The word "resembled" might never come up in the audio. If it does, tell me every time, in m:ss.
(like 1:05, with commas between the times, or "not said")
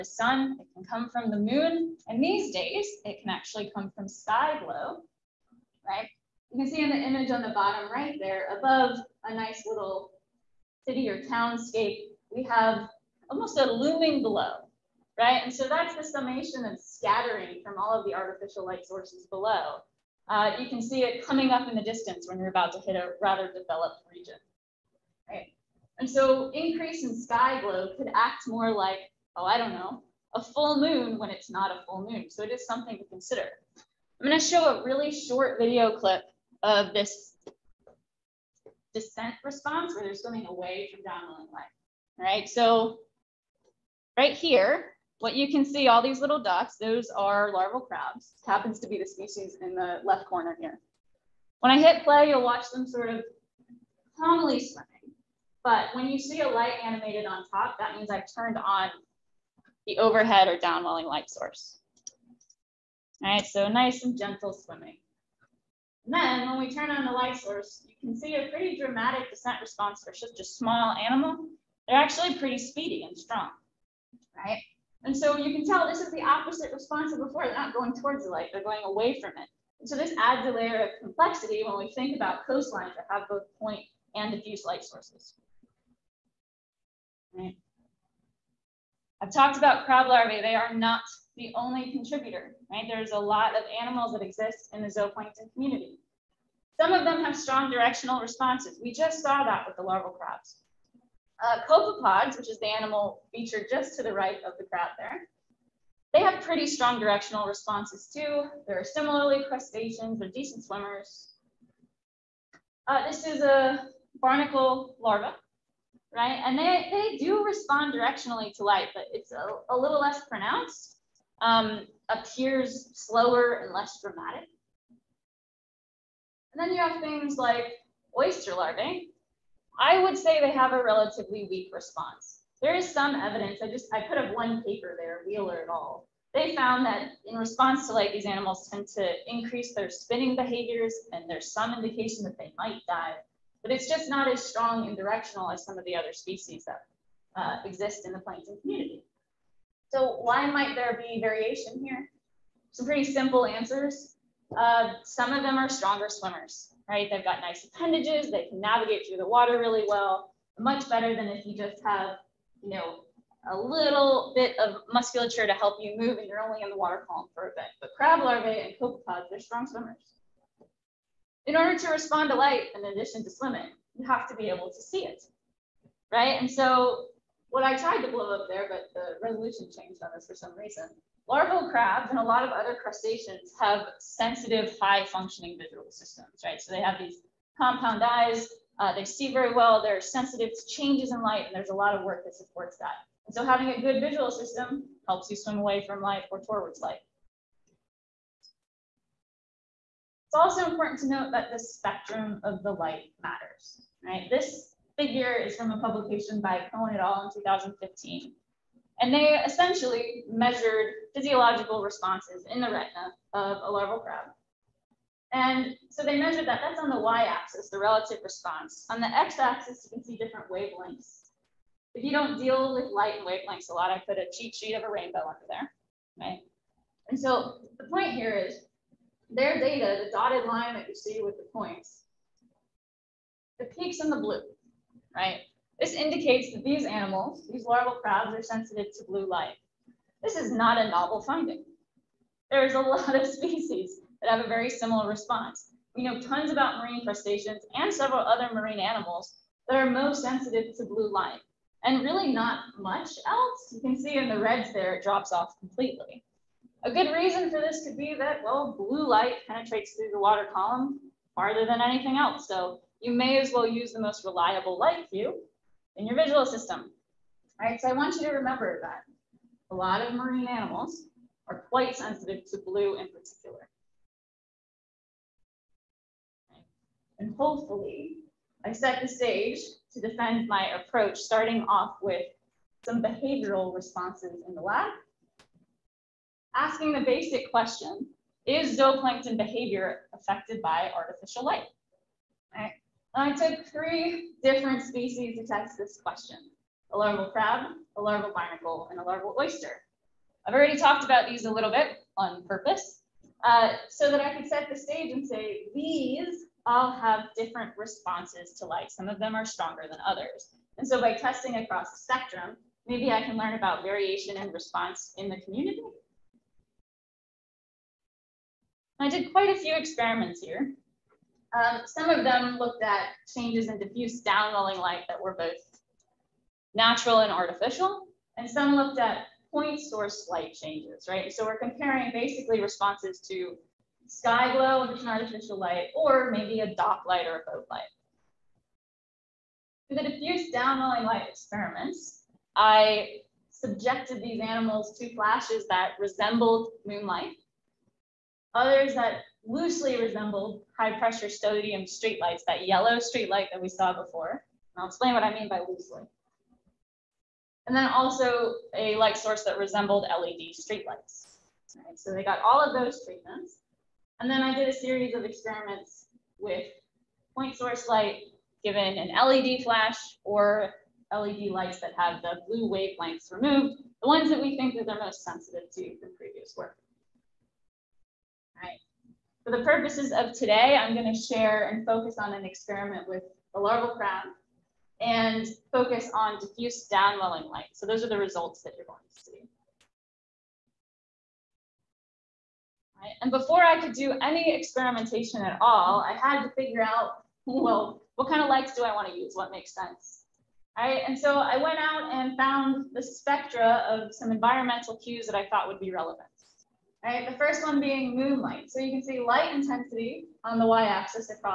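5:45, 5:49, 5:59.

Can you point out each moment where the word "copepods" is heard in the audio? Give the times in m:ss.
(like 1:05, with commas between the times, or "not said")
1:41, 2:48.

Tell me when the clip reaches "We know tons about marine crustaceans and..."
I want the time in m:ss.
4:05.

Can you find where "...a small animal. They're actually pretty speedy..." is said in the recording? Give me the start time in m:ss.
1:10.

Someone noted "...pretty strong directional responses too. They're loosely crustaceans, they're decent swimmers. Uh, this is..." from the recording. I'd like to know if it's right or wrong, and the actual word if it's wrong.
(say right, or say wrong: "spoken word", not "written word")
wrong: "similarly", not "loosely".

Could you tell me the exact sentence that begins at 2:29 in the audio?
So why might there be variation here?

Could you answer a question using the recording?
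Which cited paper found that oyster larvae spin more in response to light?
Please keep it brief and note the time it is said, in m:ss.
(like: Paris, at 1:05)
Wheeler et al., at 2:15.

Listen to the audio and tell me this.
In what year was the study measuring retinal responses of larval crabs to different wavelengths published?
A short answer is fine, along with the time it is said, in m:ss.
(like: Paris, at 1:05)
2015, at 3:27.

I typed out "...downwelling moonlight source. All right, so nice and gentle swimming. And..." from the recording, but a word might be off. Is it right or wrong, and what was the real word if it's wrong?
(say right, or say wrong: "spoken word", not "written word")
wrong: "light", not "moonlight".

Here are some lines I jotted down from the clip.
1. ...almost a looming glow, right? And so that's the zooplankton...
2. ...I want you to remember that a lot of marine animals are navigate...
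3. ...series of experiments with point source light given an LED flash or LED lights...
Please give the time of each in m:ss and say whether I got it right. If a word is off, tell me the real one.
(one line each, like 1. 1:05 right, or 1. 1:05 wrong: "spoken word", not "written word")
1. 0:13 wrong: "summation", not "zooplankton"
2. 4:27 wrong: "quite", not "navigate"
3. 6:04 right.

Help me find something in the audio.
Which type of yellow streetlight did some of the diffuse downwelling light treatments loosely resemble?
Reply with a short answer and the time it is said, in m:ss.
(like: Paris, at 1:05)
High pressure sodium, at 5:50.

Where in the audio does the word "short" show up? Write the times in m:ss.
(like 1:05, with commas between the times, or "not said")
0:35.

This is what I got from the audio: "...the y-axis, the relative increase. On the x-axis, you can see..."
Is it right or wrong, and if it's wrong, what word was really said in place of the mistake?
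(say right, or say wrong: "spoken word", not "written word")
wrong: "response", not "increase".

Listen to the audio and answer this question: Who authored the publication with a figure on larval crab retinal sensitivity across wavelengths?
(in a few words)
Cohen et al.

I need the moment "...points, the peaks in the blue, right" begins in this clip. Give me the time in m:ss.
3:51.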